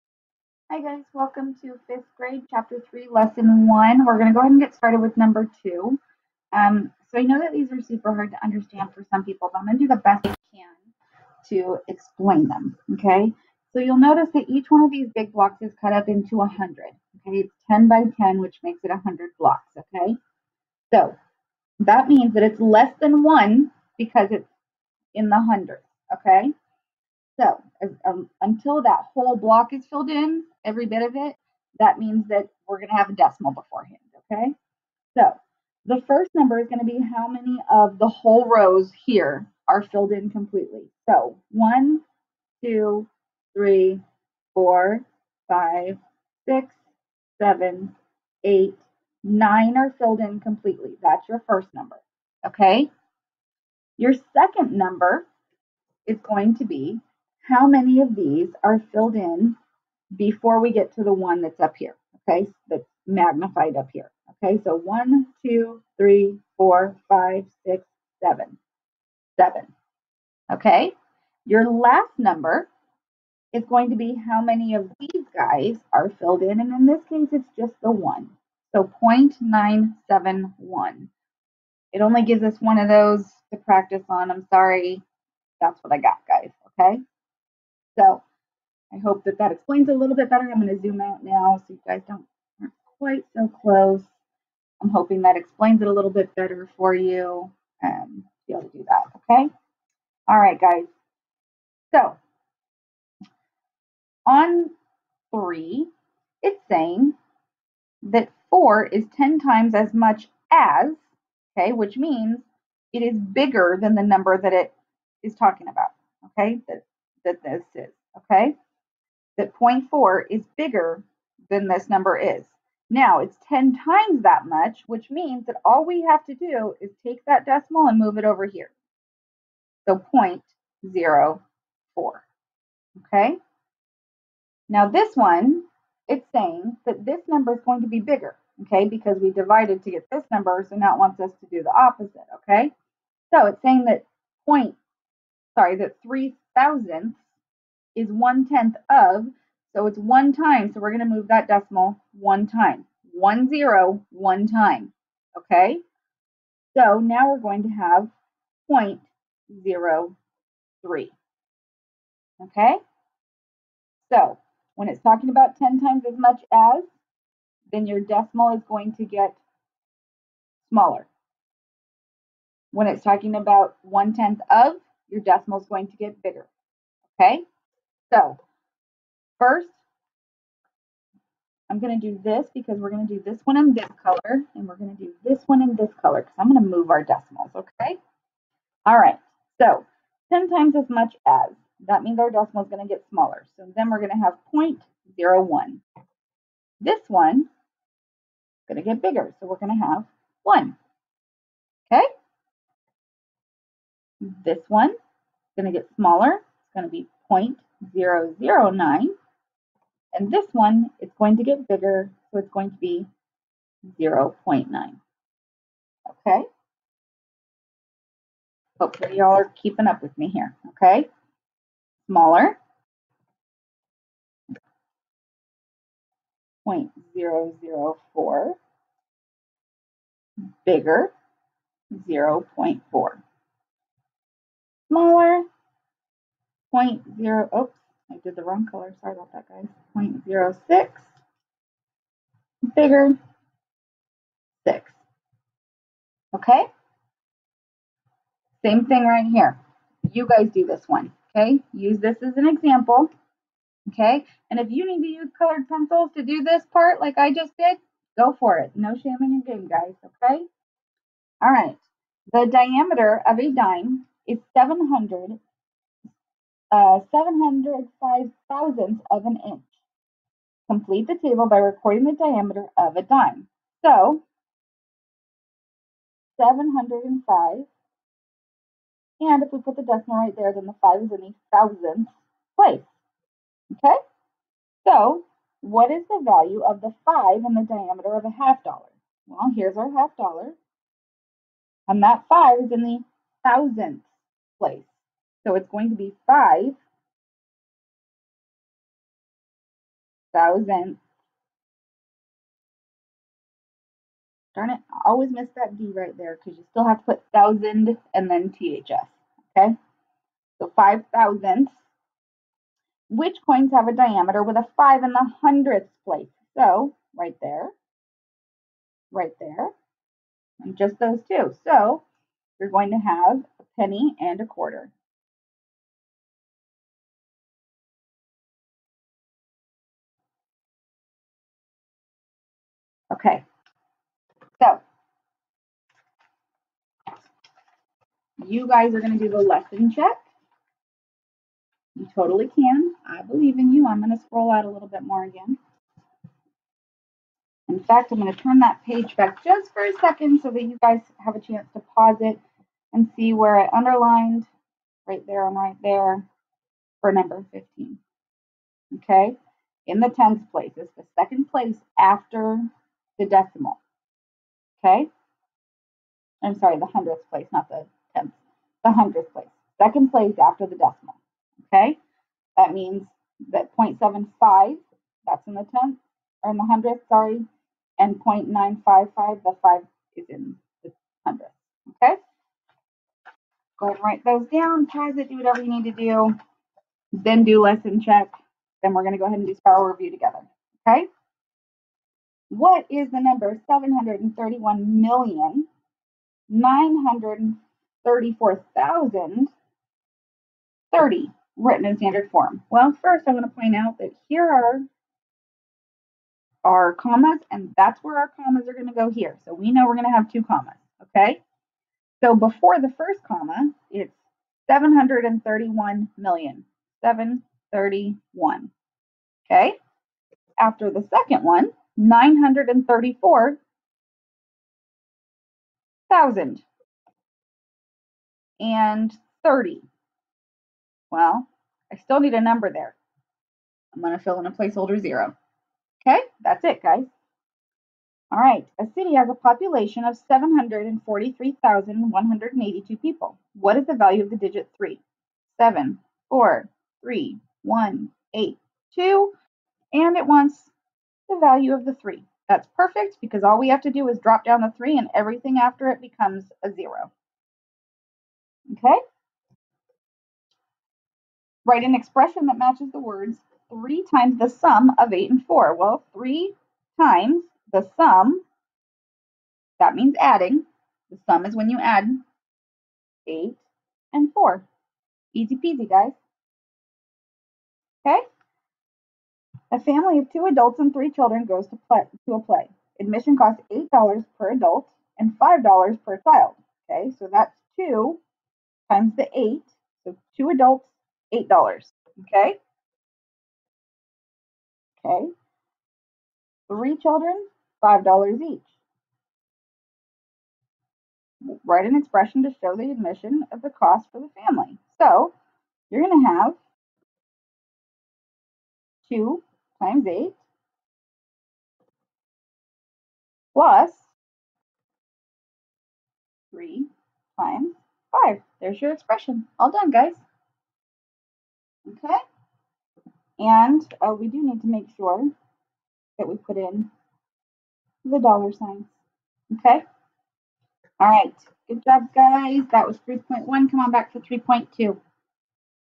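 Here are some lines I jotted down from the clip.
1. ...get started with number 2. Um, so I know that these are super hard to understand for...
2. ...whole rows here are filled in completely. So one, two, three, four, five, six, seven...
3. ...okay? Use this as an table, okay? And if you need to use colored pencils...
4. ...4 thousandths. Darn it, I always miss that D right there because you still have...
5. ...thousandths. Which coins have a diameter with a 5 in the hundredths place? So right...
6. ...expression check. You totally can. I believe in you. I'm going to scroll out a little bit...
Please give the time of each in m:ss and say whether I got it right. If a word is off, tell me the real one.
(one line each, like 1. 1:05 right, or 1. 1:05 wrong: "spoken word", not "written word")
1. 0:04 right
2. 0:38 right
3. 4:11 wrong: "example", not "table"
4. 4:56 wrong: "5", not "4"
5. 5:11 right
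6. 5:39 wrong: "lesson", not "expression".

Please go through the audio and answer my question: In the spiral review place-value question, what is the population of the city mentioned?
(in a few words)
743,182.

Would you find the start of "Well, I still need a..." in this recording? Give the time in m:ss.
7:11.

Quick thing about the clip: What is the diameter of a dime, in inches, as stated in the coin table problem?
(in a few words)
705 thousandths.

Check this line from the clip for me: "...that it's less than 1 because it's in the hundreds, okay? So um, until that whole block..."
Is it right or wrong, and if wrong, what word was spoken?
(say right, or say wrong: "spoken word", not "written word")
right.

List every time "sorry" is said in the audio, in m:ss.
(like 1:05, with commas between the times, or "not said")
1:24, 2:25, 3:59, 6:06, 6:17.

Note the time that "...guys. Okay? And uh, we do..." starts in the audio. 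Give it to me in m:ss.
8:39.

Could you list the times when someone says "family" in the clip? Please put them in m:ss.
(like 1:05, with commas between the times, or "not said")
7:59, 8:24.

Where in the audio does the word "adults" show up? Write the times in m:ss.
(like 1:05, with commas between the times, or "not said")
8:00, 8:04, 8:10.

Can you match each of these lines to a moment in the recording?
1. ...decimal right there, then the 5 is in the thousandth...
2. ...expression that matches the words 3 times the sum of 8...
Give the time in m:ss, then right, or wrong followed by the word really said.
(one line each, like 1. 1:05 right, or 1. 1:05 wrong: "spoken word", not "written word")
1. 4:39 right
2. 7:41 right.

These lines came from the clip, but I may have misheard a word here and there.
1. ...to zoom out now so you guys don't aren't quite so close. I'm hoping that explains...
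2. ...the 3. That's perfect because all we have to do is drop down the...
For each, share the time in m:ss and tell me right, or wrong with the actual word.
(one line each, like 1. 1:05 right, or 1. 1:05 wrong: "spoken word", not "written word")
1. 1:30 right
2. 7:31 right.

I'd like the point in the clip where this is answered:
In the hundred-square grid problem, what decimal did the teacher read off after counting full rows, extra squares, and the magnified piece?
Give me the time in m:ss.
1:19.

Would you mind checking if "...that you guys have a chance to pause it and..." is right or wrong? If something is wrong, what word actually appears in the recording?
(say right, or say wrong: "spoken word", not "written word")
right.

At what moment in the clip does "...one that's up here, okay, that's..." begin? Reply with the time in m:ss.
1:01.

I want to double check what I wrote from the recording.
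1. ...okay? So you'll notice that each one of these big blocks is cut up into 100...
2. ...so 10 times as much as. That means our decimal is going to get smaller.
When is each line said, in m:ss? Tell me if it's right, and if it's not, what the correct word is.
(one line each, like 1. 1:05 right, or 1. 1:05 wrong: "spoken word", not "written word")
1. 0:12 right
2. 3:09 right.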